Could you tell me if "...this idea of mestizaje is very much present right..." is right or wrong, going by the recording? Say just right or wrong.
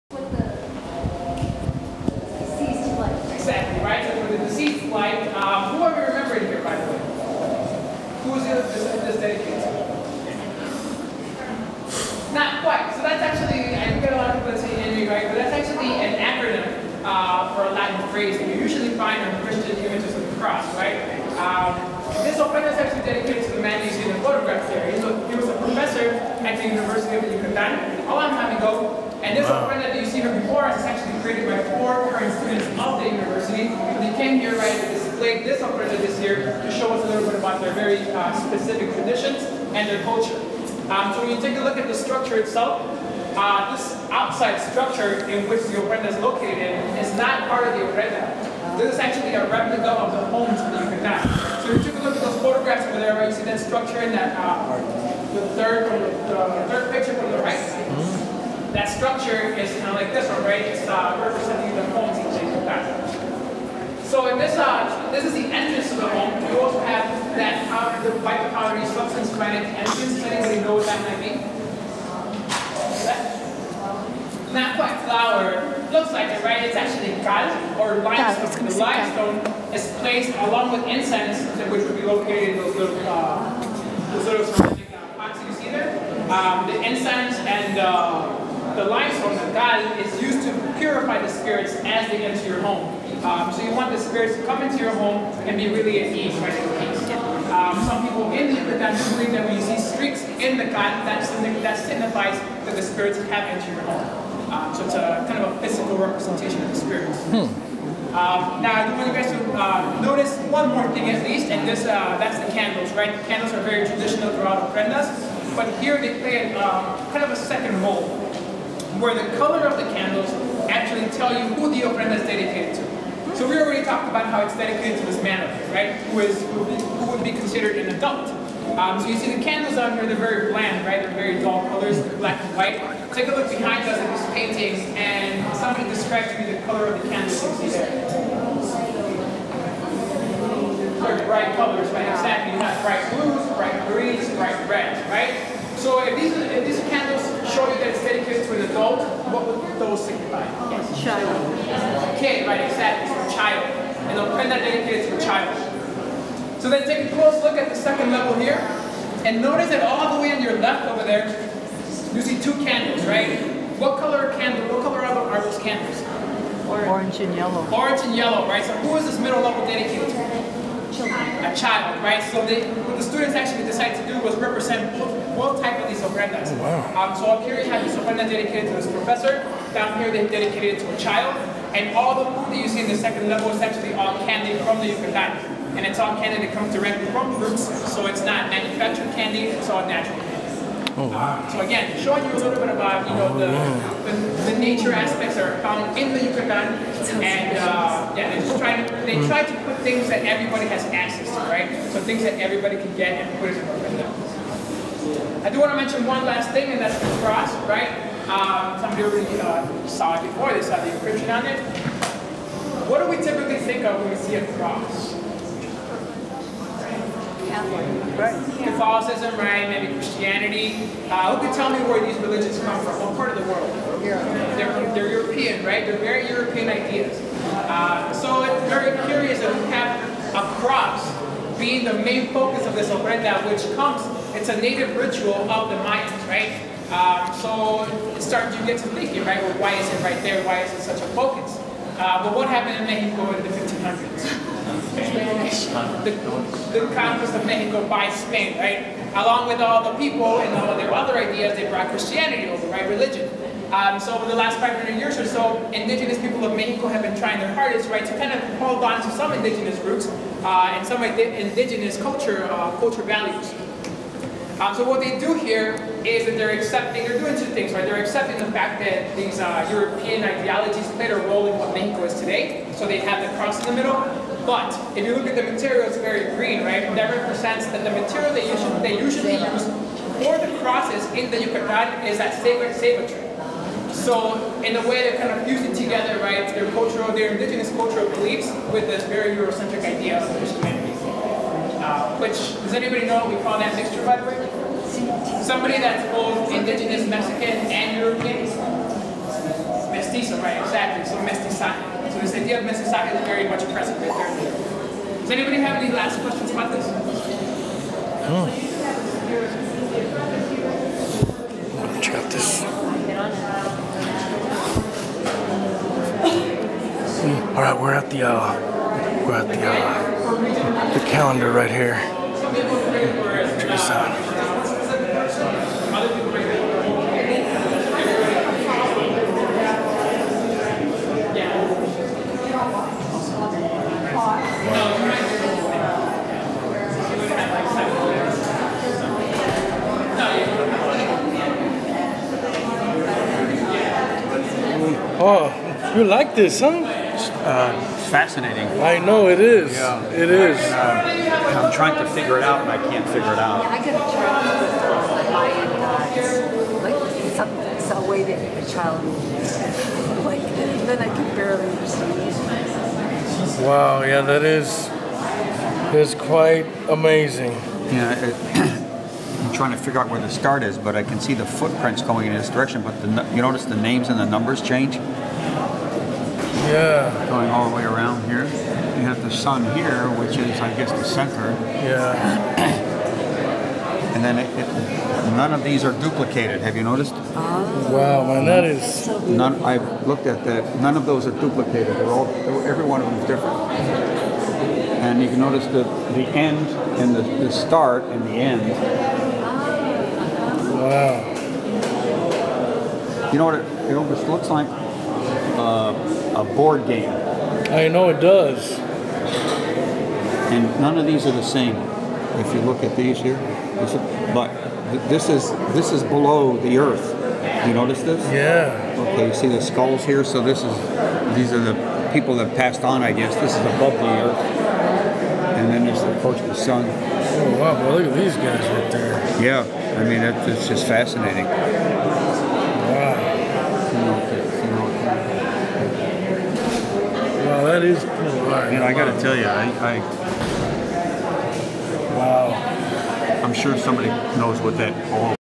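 right.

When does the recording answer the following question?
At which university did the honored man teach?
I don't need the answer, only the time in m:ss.
0:26.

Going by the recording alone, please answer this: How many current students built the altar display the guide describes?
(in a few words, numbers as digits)
4.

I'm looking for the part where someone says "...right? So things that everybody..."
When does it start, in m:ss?
3:21.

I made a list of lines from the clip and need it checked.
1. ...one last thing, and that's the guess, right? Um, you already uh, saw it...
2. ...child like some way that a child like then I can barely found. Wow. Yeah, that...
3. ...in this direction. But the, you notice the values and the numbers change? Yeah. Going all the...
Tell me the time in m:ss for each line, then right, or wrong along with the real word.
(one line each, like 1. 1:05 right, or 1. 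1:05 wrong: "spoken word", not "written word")
1. 3:26 wrong: "cross", not "guess"
2. 5:56 wrong: "understand", not "found"
3. 6:12 wrong: "names", not "values".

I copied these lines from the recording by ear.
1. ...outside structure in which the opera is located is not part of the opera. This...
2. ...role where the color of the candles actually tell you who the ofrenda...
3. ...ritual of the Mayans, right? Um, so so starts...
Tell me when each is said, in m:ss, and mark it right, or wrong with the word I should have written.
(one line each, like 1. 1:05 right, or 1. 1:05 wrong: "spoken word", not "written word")
1. 0:44 right
2. 1:57 right
3. 3:54 right.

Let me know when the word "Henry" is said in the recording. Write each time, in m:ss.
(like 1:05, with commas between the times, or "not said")
0:14.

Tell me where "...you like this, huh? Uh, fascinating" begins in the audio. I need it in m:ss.
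5:45.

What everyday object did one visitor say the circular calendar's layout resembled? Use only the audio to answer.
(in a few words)
A board game.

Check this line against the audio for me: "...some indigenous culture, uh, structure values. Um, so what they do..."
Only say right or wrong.
wrong.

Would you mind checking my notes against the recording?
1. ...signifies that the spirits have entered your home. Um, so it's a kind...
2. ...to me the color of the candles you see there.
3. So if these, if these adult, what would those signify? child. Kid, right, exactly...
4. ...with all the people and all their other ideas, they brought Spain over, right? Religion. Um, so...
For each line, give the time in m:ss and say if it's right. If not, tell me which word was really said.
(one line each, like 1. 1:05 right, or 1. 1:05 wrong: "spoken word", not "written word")
1. 1:41 right
2. 2:16 right
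3. 2:25 right
4. 4:09 wrong: "Christianity", not "Spain".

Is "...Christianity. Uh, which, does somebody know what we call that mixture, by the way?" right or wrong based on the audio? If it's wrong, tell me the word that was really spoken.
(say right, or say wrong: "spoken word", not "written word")
wrong: "anybody", not "somebody".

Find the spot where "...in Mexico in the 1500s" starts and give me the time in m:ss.
4:02.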